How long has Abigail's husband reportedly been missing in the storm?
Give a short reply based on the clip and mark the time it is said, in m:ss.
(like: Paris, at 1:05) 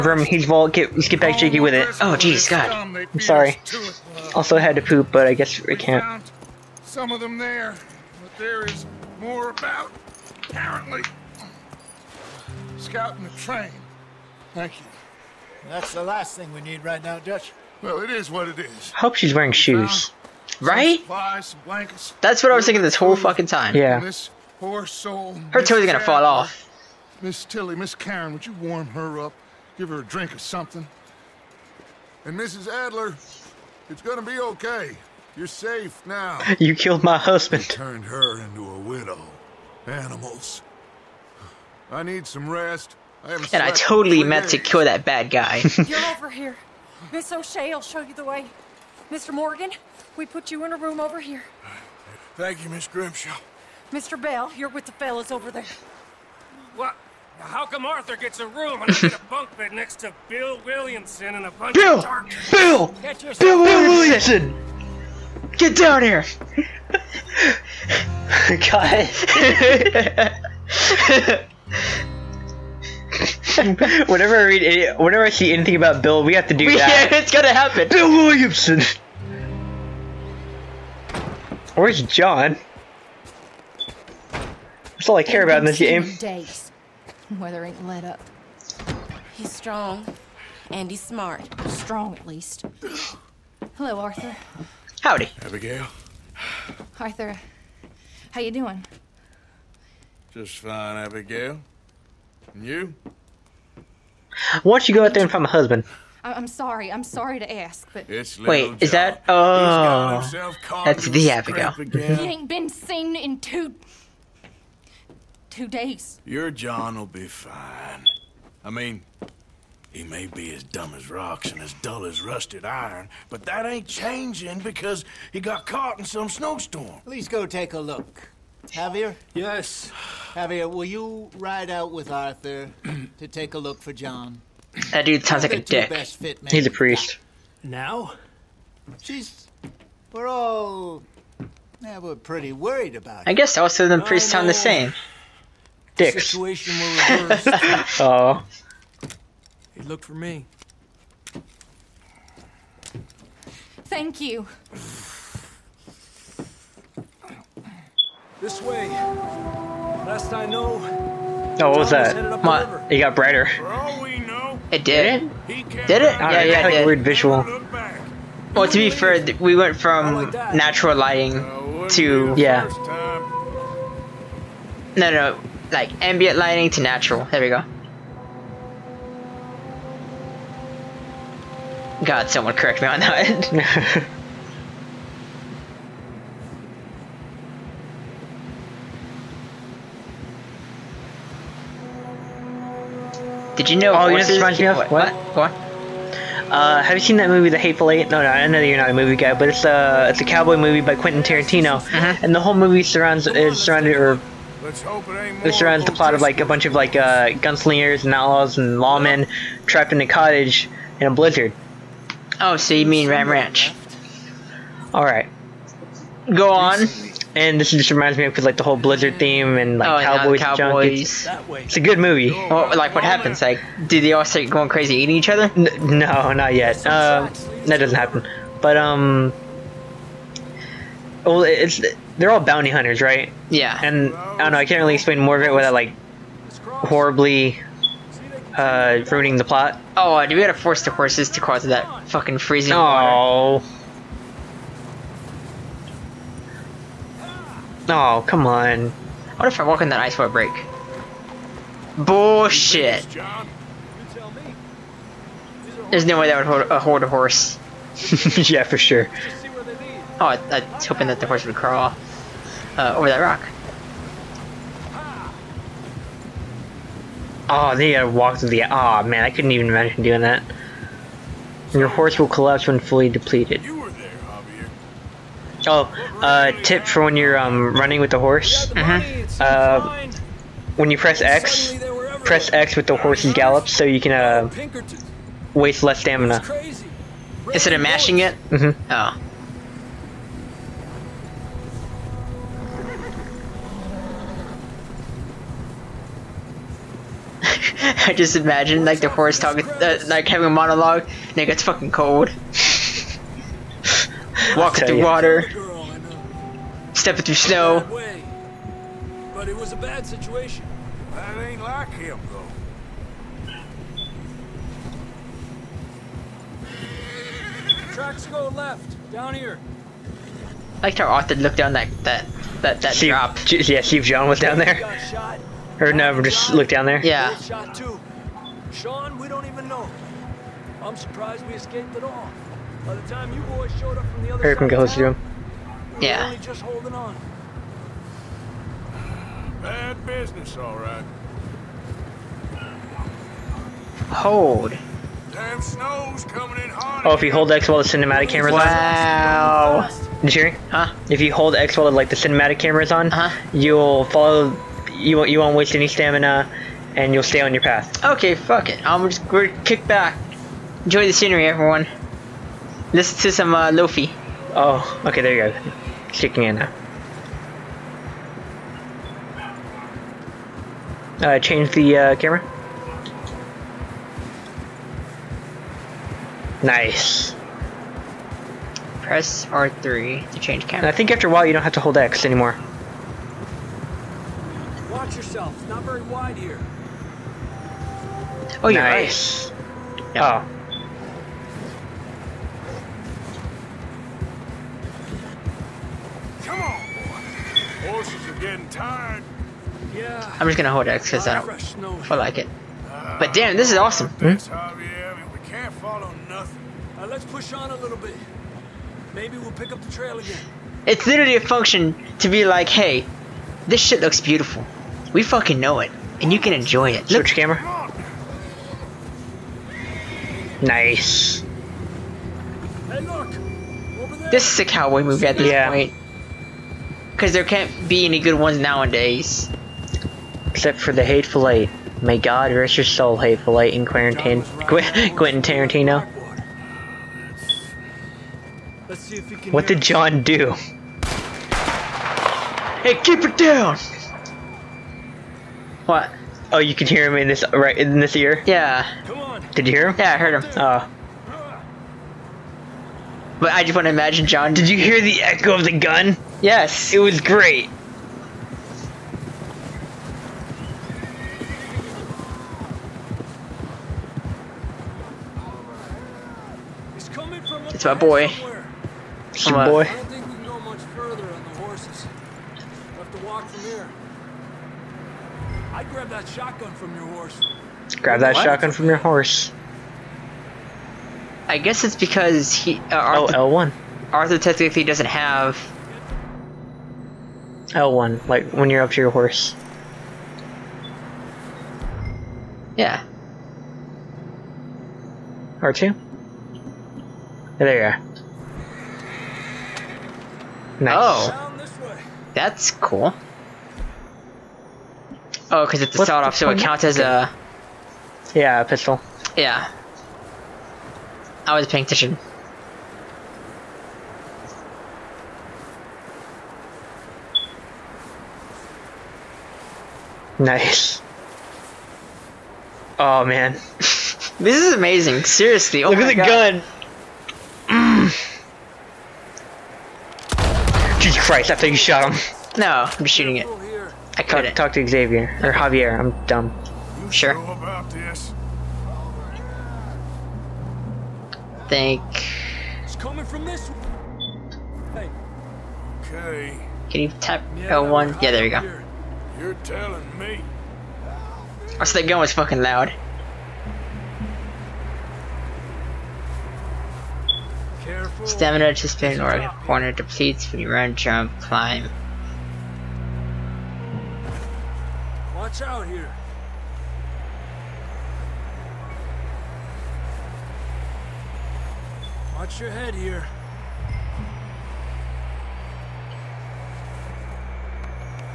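two days, at 1:53.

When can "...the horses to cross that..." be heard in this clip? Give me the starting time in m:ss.
4:00.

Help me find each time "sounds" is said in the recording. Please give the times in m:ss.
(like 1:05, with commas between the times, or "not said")
2:15, 2:24.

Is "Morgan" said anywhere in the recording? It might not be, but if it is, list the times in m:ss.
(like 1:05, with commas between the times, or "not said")
0:49.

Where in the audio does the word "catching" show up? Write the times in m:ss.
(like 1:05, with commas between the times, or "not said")
not said.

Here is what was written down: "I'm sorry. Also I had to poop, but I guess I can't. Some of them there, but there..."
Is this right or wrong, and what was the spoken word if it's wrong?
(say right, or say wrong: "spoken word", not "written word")
right.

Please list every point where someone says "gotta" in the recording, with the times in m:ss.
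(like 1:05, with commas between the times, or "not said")
4:00, 4:27.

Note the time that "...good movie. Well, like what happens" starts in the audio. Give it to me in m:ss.
3:41.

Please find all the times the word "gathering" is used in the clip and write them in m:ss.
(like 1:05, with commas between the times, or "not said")
not said.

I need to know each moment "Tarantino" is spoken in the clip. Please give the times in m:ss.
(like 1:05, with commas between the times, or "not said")
3:21, 7:15.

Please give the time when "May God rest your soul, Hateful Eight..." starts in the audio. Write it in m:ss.
7:12.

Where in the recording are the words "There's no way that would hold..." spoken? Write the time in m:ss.
4:15.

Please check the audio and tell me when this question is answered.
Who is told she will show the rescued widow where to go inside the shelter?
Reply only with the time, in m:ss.
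0:47.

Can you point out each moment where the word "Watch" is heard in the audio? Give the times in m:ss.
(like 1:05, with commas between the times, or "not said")
6:24, 9:25, 9:32.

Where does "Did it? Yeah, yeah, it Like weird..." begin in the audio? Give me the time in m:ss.
2:45.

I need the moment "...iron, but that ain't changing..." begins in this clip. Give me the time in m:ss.
2:02.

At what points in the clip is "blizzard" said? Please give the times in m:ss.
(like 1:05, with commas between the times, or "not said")
3:31, 3:38.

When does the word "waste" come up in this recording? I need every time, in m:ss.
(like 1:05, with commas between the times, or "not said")
4:45, 5:55.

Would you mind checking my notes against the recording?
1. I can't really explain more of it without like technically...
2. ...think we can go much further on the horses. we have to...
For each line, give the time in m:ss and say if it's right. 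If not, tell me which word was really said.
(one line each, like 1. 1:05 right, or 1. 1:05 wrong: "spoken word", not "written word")
1. 3:54 wrong: "horribly", not "technically"
2. 7:50 right.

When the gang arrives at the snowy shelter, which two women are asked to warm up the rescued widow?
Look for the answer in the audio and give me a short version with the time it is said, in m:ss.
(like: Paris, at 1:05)
Miss Tilly, Miss Karen, at 0:27.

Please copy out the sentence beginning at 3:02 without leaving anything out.
God, someone correct me on that.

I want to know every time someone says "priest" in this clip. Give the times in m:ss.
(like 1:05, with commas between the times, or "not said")
2:16, 2:23.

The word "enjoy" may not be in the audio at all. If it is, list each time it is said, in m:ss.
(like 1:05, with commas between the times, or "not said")
6:00, 6:56.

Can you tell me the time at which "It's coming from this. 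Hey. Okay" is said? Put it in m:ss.
9:02.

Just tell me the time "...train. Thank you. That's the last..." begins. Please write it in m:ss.
0:13.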